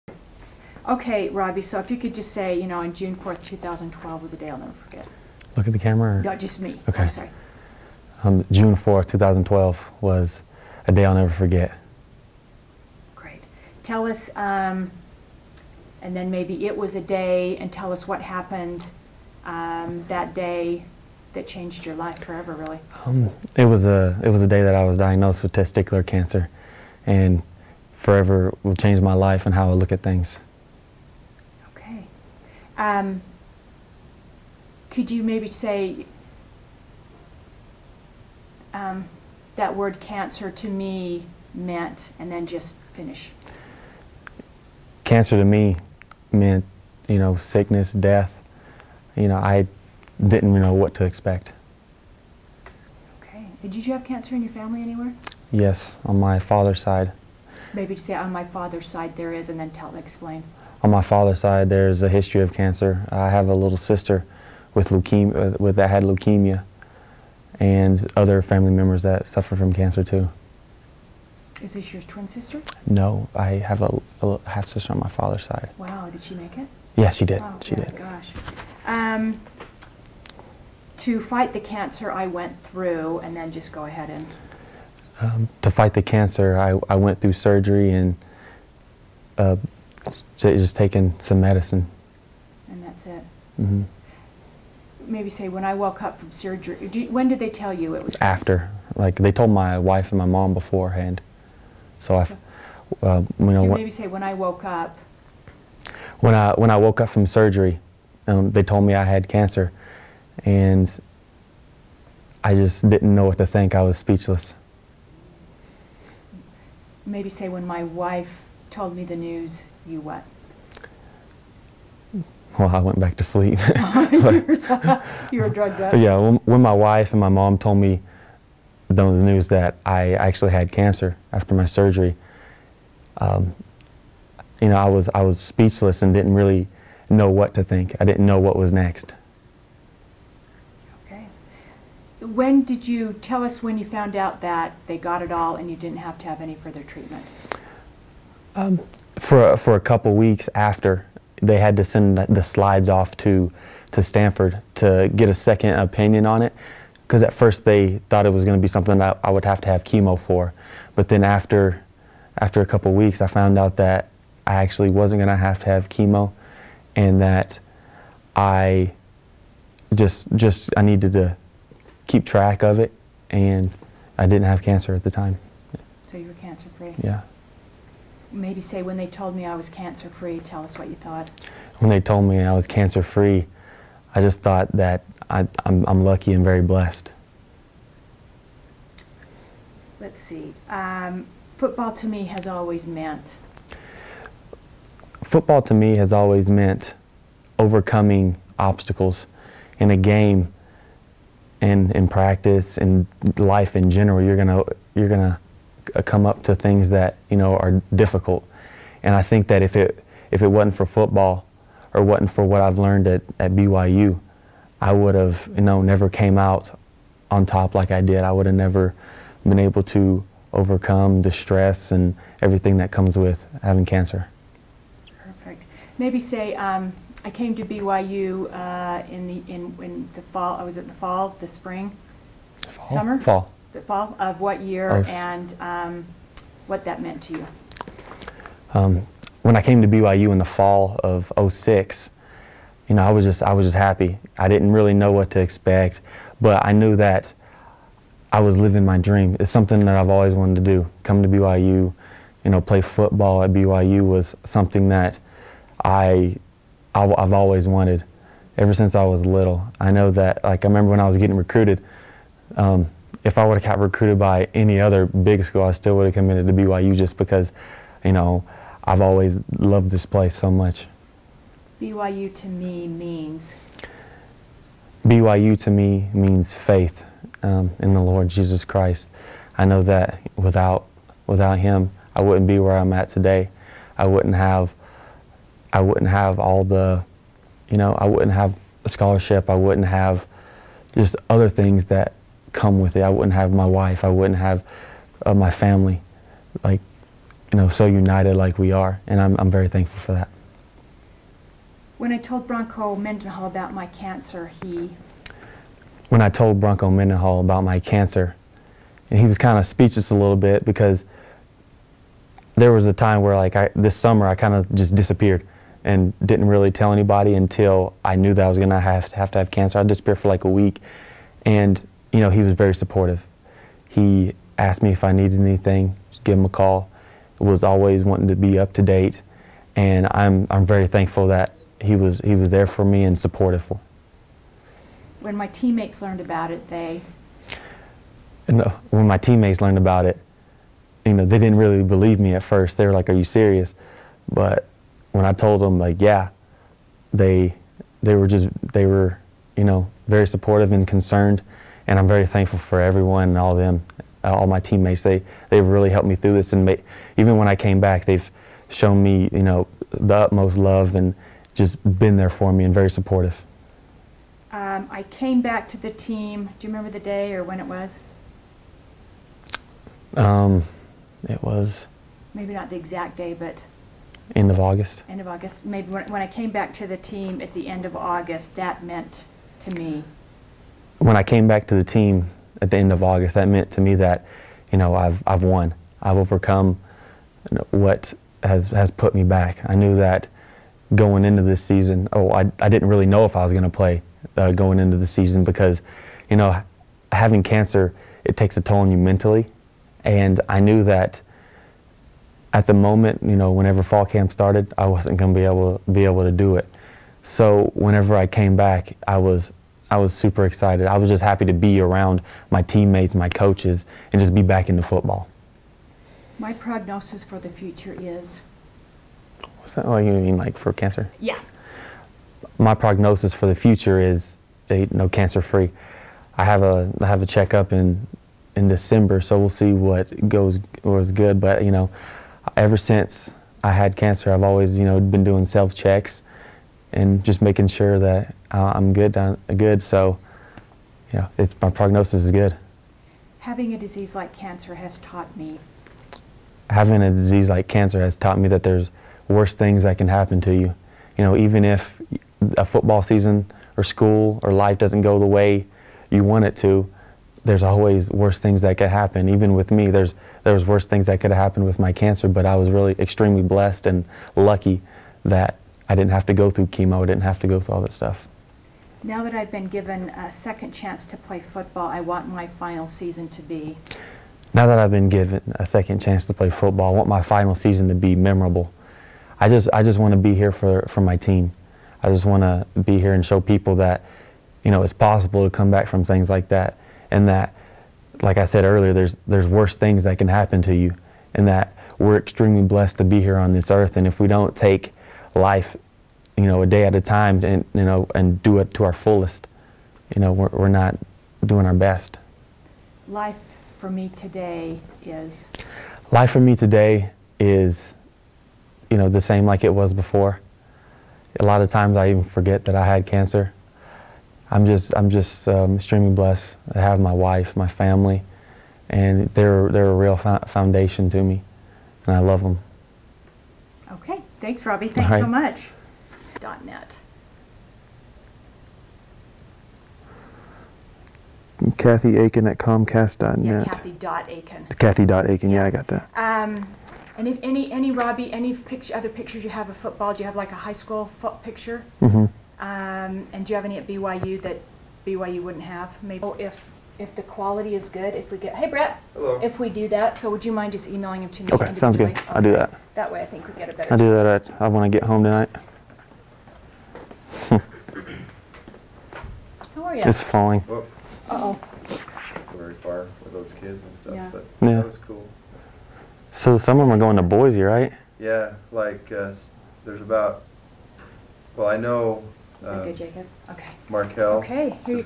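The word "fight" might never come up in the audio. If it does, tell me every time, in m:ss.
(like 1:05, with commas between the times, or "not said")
1:21, 1:25.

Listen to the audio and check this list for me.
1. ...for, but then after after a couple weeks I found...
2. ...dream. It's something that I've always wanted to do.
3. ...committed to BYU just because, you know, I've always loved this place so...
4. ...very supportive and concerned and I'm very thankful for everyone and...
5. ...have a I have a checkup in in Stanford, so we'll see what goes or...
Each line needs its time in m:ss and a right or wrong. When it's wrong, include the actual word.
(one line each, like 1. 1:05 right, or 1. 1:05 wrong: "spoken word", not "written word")
1. 2:40 right
2. 4:08 right
3. 4:26 right
4. 5:50 right
5. 7:06 wrong: "December", not "Stanford".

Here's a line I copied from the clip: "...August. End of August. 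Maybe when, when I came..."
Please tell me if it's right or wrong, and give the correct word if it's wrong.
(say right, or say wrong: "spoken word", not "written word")
right.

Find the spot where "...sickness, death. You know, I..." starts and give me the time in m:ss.
0:47.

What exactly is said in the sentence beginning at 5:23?
He asked me if I needed anything, just give him a call.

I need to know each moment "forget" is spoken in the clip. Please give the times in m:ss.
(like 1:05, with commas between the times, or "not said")
0:04, 0:11, 8:32.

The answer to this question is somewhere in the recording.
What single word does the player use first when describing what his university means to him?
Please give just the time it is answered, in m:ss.
4:36.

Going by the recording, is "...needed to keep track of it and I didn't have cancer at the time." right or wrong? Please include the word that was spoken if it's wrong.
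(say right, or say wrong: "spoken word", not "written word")
right.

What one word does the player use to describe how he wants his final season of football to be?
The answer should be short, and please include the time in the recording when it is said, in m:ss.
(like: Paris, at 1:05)
Memorable, at 7:58.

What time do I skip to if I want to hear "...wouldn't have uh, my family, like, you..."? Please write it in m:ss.
4:54.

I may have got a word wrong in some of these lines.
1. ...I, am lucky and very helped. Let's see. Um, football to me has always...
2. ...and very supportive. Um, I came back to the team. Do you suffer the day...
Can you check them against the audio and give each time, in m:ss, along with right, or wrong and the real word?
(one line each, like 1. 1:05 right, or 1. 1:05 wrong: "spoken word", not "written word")
1. 3:05 wrong: "blessed", not "helped"
2. 6:02 wrong: "remember", not "suffer".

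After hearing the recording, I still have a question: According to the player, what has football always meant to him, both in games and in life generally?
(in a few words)
Overcoming obstacles.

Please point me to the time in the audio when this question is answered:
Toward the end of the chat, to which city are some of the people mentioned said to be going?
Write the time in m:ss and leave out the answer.
9:27.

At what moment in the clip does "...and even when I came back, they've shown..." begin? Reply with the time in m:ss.
5:56.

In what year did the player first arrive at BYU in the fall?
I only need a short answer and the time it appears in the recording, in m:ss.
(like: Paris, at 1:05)
2006, at 4:01.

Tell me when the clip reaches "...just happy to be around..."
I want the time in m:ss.
6:51.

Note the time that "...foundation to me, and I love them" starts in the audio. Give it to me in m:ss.
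8:40.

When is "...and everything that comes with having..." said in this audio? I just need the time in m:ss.
3:41.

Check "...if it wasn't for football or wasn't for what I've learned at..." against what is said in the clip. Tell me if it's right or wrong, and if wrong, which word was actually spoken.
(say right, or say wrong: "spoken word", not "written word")
right.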